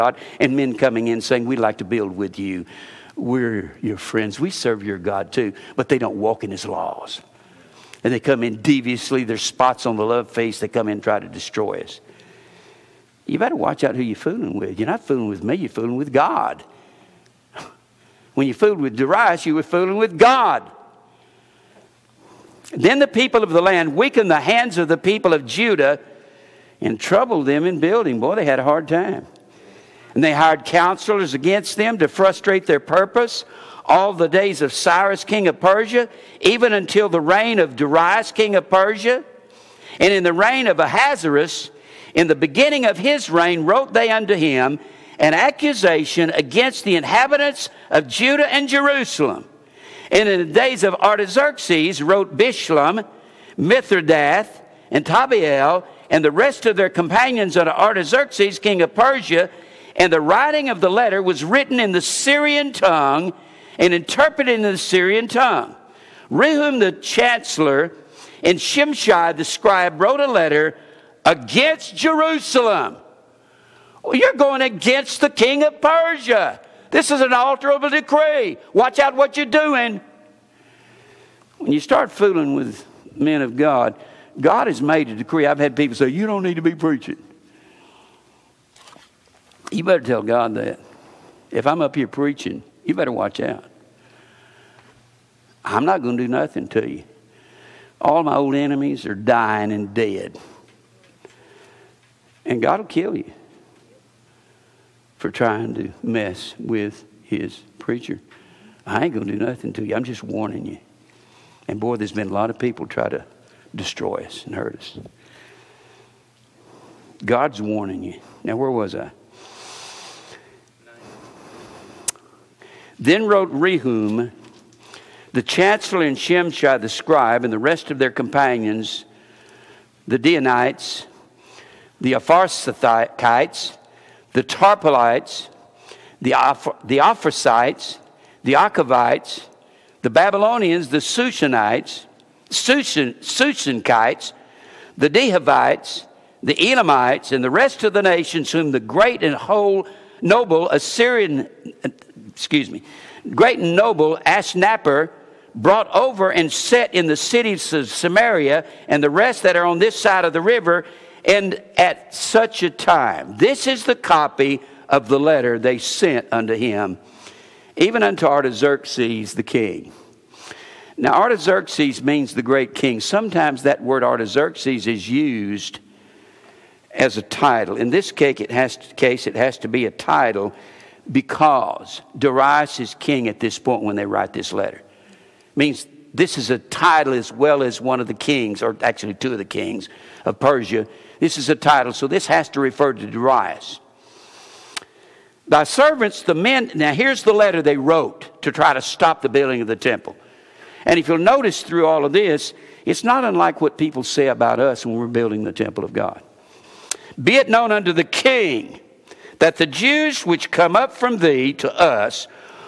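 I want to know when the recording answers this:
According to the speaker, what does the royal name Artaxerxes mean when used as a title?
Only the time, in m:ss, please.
2:52.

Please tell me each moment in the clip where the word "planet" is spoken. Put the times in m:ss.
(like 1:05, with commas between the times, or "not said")
not said.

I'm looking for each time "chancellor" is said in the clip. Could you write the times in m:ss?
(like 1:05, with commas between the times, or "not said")
1:06, 2:05.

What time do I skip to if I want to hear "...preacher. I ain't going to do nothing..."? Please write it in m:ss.
1:47.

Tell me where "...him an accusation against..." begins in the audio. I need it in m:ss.
0:44.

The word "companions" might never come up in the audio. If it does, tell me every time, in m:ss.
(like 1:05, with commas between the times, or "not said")
0:56, 2:08.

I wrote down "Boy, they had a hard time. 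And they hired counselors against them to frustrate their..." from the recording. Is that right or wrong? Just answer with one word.
right.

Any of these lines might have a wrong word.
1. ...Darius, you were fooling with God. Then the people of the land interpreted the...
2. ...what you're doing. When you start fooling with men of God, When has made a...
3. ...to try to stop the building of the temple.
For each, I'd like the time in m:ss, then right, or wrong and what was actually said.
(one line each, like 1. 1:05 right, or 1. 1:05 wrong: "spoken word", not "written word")
1. 0:18 wrong: "weakened", not "interpreted"
2. 1:19 wrong: "God", not "When"
3. 3:18 right.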